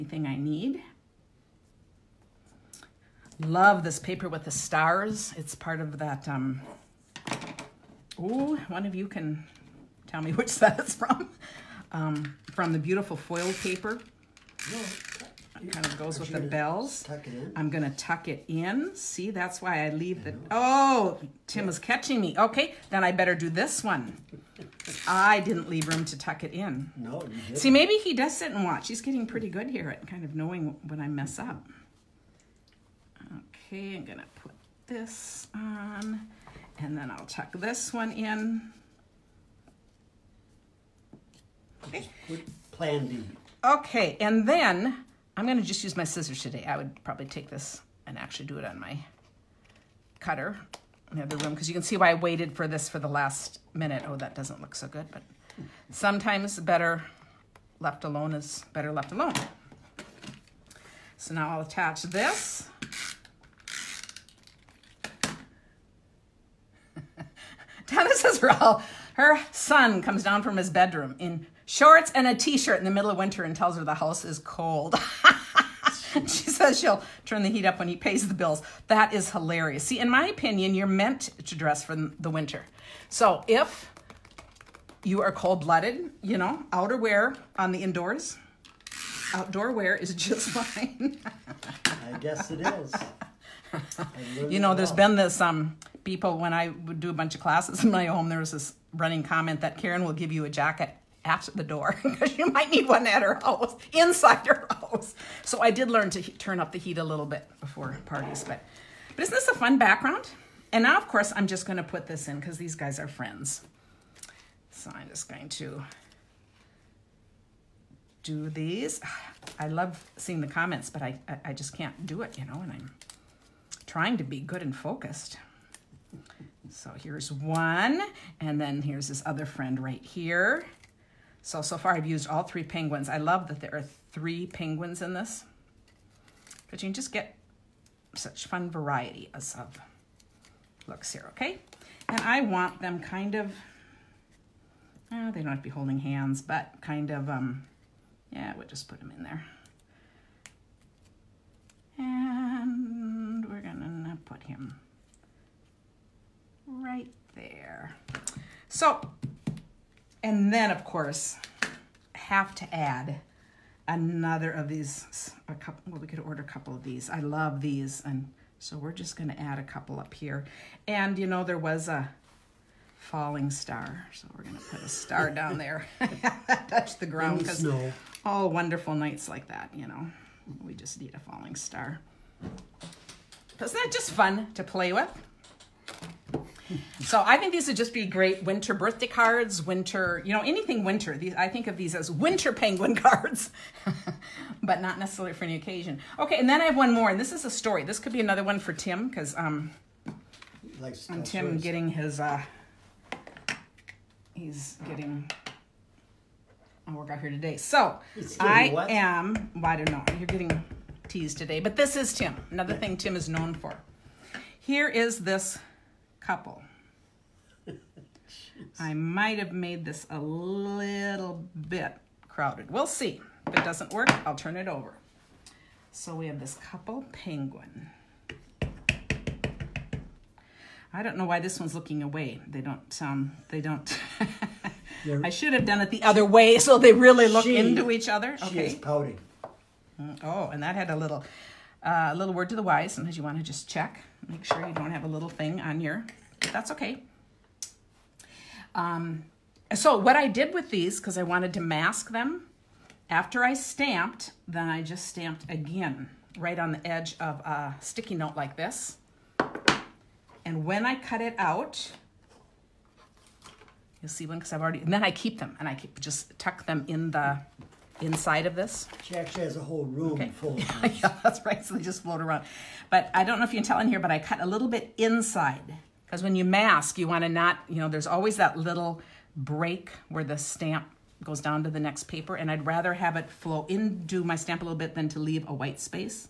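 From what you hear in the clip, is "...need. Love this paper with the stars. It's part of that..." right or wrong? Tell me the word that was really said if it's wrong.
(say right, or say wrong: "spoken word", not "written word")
right.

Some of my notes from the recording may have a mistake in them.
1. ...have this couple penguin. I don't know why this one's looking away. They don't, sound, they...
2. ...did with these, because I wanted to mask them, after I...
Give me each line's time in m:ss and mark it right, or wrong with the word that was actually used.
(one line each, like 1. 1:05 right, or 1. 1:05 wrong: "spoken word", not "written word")
1. 3:46 right
2. 4:10 right.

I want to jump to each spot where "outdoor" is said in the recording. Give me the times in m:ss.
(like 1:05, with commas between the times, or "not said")
1:29.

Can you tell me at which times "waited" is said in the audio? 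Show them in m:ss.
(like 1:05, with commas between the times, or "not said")
0:52.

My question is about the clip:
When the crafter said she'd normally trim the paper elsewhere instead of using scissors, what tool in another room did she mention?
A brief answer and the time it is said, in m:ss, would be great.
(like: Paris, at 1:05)
cutter, at 0:50.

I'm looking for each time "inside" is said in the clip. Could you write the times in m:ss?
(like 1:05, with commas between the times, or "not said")
1:43, 4:28, 4:34.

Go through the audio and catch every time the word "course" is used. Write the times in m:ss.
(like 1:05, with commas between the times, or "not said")
1:51, 2:40.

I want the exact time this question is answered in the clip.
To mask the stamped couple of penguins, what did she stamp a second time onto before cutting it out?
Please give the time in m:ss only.
4:17.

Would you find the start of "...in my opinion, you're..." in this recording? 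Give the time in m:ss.
1:19.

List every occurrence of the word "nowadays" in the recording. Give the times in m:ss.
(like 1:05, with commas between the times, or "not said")
not said.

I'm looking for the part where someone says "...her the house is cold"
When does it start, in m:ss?
1:13.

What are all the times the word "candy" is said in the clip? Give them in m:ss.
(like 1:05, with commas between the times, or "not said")
not said.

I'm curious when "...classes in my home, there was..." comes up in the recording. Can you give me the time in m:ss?
1:37.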